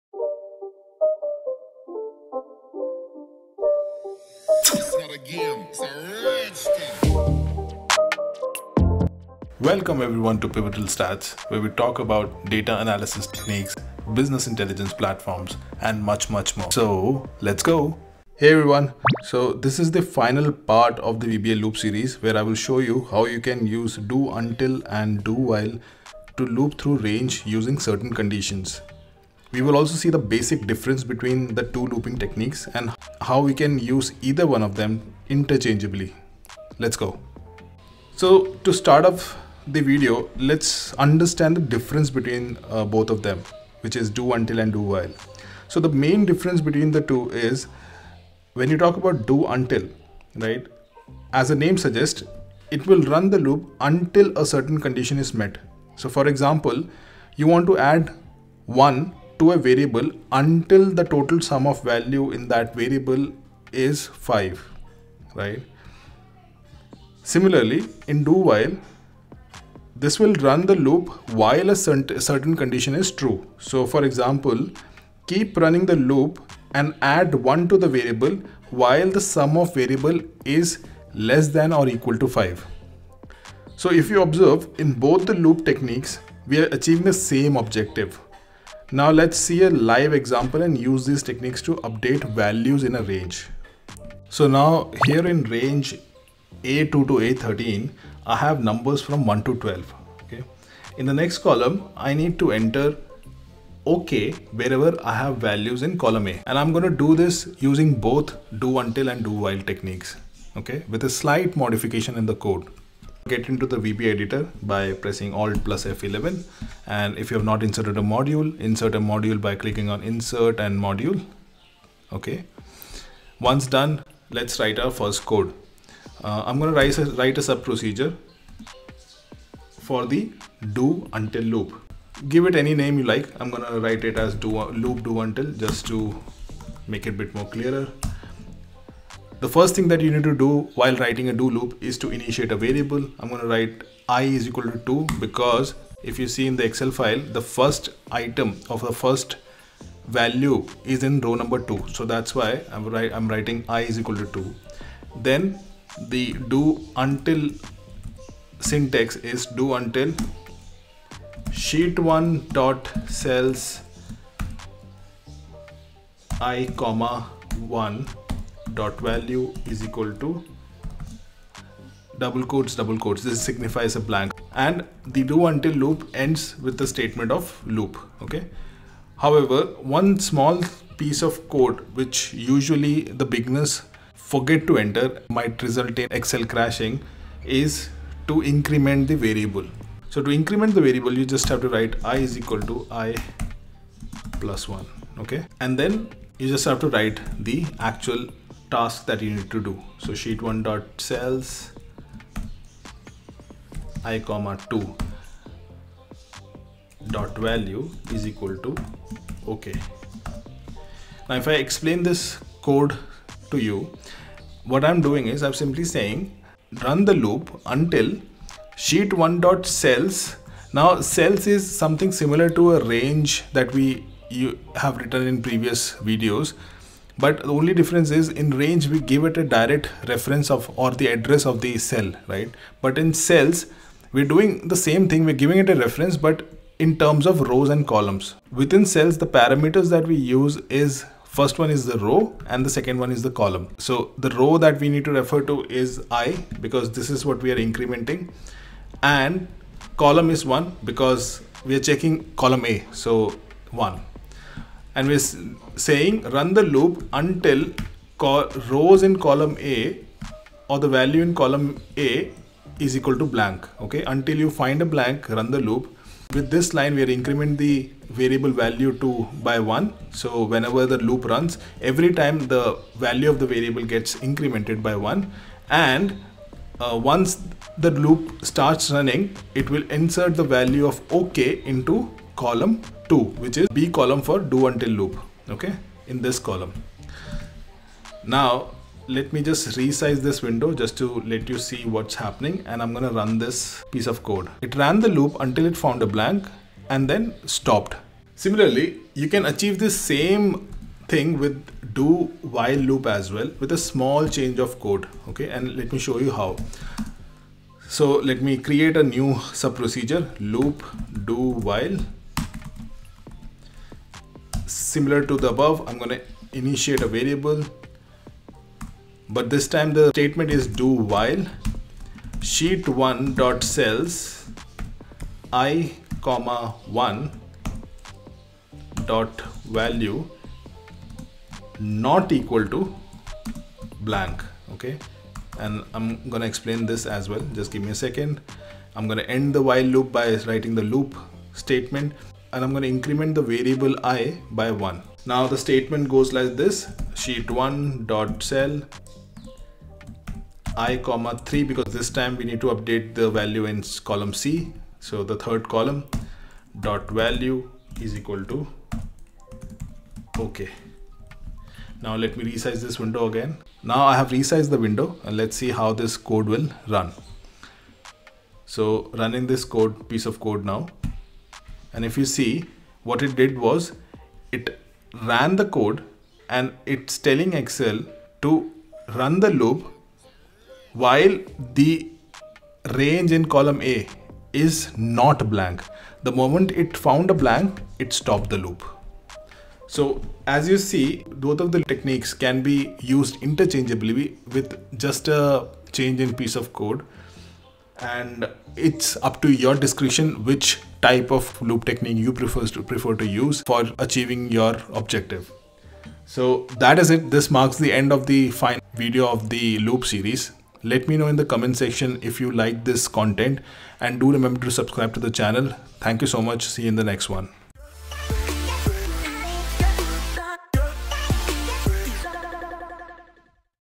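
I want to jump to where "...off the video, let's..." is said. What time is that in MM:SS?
00:39.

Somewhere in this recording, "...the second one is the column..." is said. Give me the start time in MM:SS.
04:02.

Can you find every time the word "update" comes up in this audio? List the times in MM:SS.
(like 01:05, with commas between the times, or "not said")
01:31, 05:52.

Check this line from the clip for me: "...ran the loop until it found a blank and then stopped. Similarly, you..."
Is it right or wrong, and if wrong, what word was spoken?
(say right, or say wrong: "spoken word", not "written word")
right.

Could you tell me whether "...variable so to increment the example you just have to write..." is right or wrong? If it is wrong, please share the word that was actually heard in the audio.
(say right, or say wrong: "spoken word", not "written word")
wrong: "variable", not "example".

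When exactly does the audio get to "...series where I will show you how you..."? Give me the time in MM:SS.
00:21.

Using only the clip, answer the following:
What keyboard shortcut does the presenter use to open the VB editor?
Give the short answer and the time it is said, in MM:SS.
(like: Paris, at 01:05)
Alt plus F11, at 01:55.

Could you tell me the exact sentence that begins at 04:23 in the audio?
Okay, until you find a blank, run the loop.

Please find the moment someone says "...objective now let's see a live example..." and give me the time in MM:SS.
01:27.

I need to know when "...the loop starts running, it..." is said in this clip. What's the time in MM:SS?
04:37.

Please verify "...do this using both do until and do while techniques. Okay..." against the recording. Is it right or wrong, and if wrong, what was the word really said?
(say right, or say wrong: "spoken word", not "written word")
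right.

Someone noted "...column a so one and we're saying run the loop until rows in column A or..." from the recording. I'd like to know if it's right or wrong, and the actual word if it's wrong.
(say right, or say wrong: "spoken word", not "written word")
right.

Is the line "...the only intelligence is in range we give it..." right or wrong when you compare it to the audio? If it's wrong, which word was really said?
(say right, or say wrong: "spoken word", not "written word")
wrong: "difference", not "intelligence".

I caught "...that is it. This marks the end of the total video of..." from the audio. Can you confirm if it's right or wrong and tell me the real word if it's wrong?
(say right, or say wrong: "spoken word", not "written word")
wrong: "final", not "total".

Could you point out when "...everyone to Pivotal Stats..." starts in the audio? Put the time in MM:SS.
00:10.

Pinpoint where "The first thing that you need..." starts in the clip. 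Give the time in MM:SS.
02:19.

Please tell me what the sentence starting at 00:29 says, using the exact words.
We will also see the basic difference between the two looping techniques and how we can use either one of them interchangeably.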